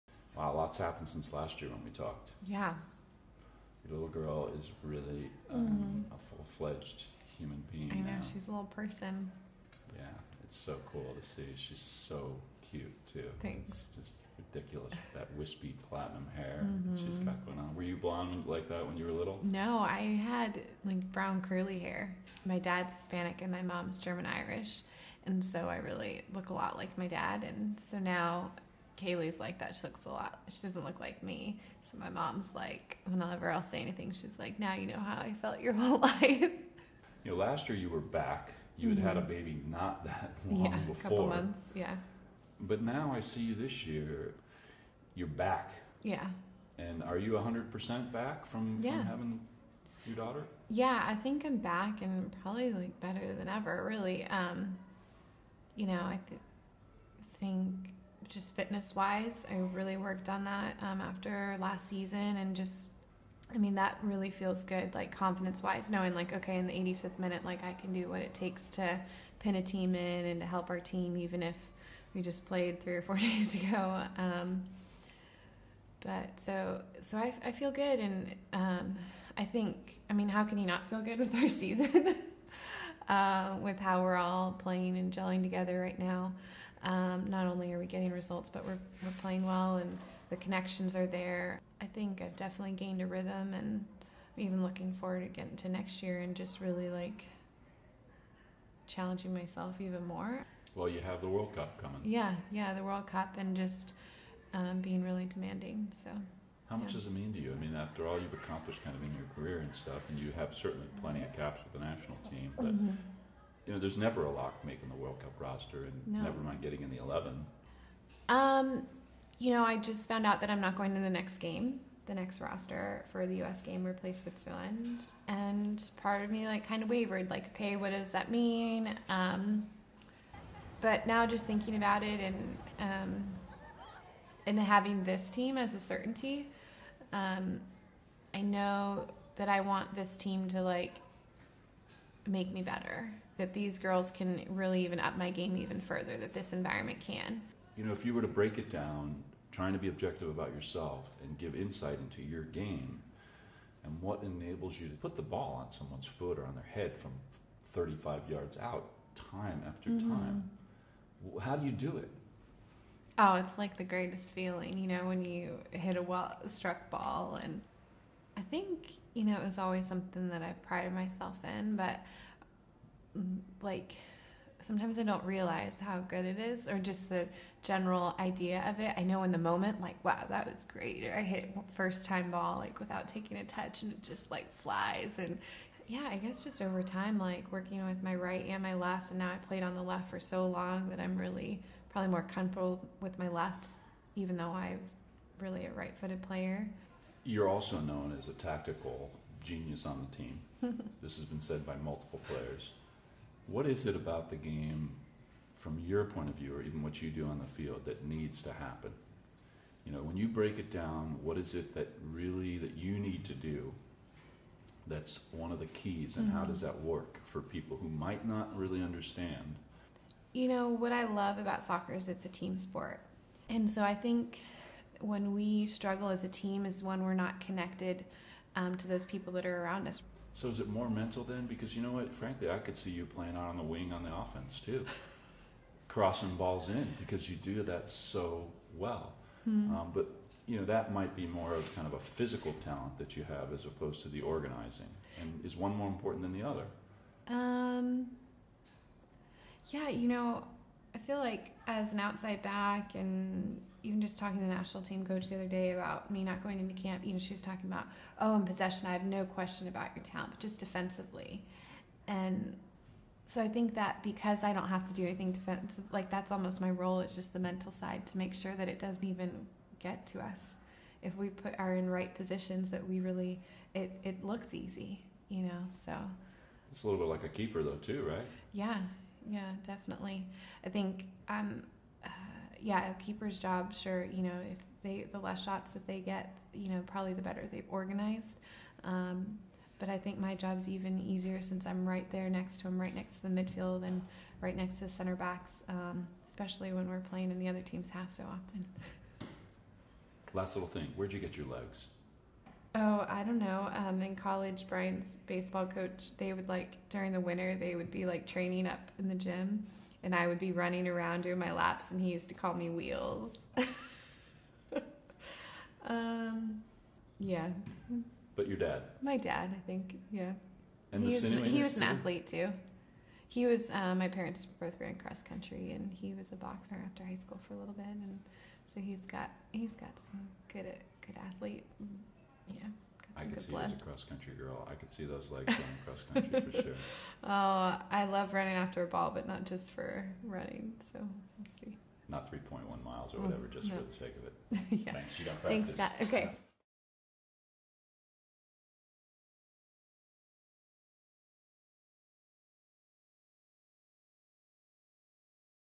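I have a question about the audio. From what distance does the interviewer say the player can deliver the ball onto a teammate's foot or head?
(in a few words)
35 yards.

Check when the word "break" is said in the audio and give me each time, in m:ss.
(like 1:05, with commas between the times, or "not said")
2:28, 3:30.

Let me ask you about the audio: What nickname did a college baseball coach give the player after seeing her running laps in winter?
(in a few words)
Wheels.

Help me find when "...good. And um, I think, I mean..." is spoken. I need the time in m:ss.
1:17.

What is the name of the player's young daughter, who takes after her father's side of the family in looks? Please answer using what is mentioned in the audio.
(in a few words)
Kaylee.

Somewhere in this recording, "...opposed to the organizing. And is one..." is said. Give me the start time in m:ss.
4:03.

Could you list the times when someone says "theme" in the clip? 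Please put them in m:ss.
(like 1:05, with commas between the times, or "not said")
not said.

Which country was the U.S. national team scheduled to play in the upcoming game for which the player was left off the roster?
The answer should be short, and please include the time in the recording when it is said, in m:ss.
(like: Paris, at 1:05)
Switzerland, at 2:04.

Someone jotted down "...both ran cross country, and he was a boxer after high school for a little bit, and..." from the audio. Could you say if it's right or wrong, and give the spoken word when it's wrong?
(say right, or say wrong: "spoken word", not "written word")
right.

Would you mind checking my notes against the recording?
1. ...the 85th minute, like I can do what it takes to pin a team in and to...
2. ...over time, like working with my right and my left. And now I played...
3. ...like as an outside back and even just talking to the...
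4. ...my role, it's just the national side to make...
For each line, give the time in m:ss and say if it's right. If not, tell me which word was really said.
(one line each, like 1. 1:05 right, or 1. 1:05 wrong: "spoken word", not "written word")
1. 1:06 right
2. 3:06 right
3. 4:11 right
4. 4:26 wrong: "mental", not "national".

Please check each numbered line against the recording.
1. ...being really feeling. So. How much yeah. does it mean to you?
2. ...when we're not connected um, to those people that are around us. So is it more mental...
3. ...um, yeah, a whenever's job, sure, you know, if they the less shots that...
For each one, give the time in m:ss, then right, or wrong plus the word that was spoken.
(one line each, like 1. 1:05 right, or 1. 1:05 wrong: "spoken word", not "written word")
1. 1:44 wrong: "demanding", not "feeling"
2. 3:46 right
3. 4:41 wrong: "keeper", not "whenever".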